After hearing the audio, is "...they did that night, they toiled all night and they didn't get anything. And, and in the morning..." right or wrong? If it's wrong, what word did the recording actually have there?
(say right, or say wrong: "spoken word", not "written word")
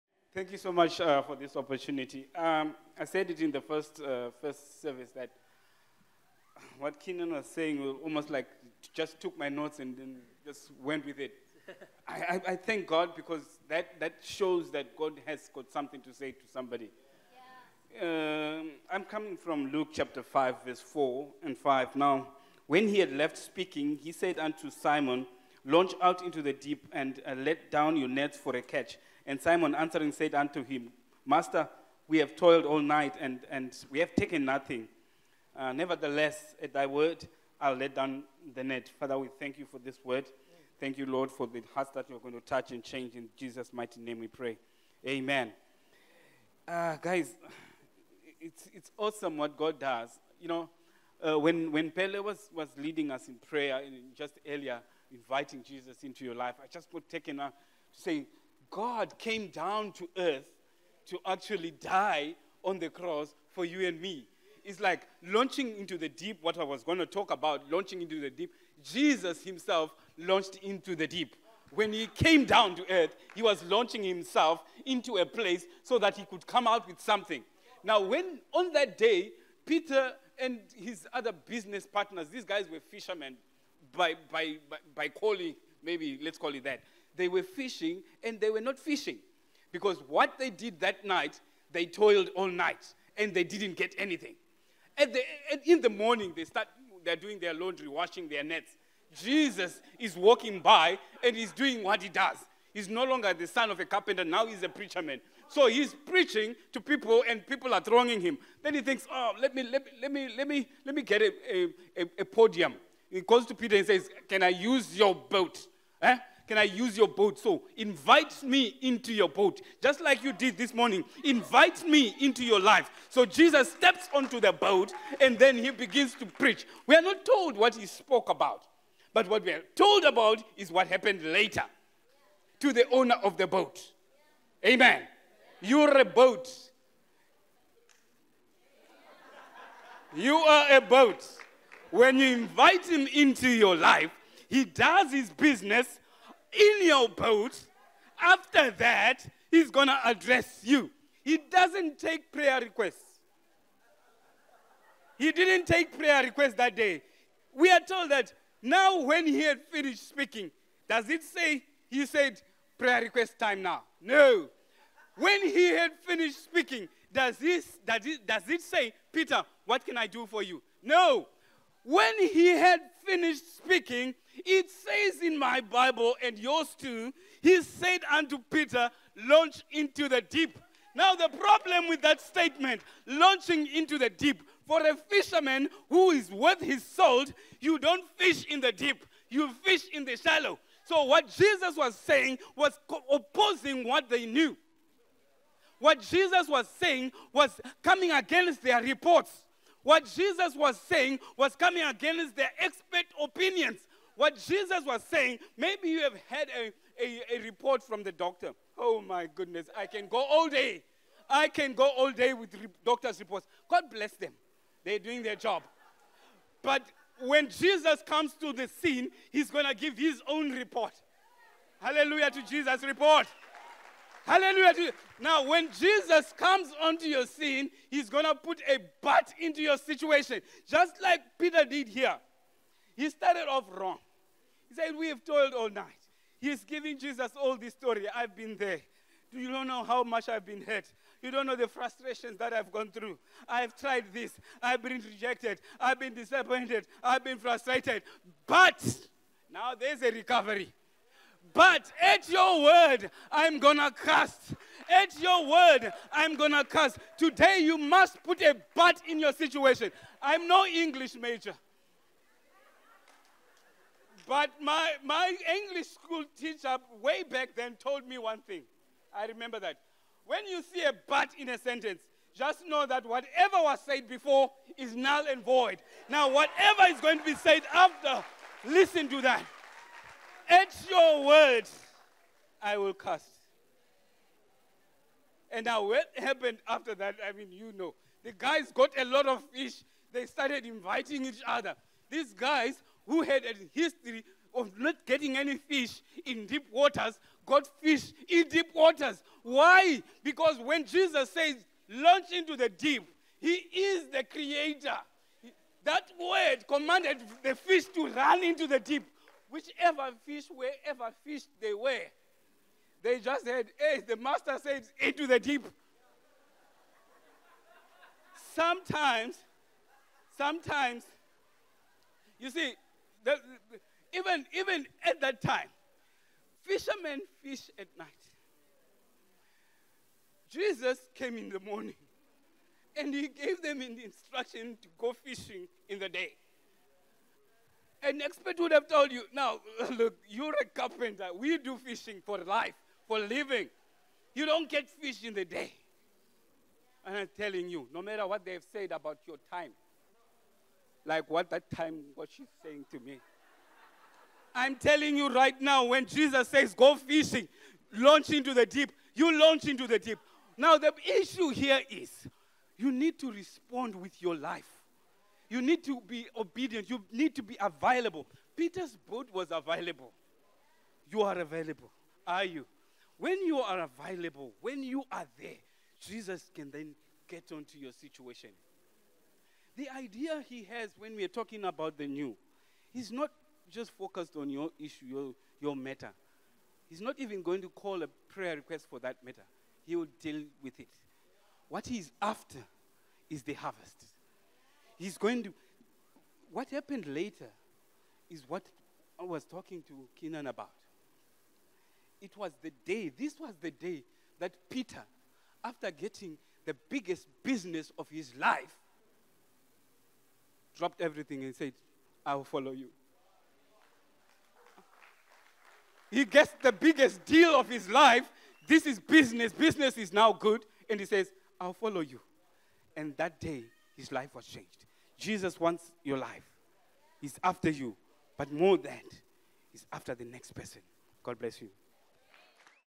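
right.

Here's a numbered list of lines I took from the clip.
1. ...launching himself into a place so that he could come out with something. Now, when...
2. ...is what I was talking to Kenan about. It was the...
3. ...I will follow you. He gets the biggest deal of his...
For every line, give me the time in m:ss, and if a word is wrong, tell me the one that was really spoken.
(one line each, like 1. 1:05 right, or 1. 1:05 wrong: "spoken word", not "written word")
1. 1:13 right
2. 6:38 right
3. 6:52 right.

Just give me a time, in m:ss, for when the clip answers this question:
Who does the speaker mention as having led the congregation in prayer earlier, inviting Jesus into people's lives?
0:51.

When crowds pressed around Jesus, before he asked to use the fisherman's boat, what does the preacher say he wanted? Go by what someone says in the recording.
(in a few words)
A podium.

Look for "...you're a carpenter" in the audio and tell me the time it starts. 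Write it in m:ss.
5:40.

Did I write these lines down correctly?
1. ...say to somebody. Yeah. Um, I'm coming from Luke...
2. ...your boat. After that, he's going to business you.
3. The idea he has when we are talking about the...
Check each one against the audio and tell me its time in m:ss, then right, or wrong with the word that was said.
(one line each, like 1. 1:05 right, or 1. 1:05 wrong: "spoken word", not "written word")
1. 0:16 right
2. 2:26 wrong: "address", not "business"
3. 6:19 right.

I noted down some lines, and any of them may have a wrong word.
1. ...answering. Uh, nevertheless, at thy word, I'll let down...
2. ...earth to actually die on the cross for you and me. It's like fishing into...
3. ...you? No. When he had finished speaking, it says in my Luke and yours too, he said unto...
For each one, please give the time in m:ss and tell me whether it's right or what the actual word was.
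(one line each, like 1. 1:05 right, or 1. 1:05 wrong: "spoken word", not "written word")
1. 0:34 wrong: "nothing", not "answering"
2. 1:00 wrong: "launching", not "fishing"
3. 2:50 wrong: "Bible", not "Luke".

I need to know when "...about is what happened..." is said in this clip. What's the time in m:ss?
2:10.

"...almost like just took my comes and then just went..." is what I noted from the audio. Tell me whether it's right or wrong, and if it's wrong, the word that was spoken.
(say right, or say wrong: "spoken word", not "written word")
wrong: "notes", not "comes".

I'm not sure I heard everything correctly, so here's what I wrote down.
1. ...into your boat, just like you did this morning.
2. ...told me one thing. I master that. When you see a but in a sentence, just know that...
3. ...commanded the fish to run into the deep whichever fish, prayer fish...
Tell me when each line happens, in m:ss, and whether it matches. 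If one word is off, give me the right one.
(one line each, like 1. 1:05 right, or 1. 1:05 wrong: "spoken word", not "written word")
1. 1:58 right
2. 4:27 wrong: "remember", not "master"
3. 5:06 wrong: "wherever", not "prayer".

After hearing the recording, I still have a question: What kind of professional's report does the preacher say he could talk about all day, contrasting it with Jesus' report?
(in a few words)
Doctor's reports.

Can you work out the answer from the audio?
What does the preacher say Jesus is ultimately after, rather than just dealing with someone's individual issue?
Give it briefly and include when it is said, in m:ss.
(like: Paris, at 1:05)
The harvest, at 6:33.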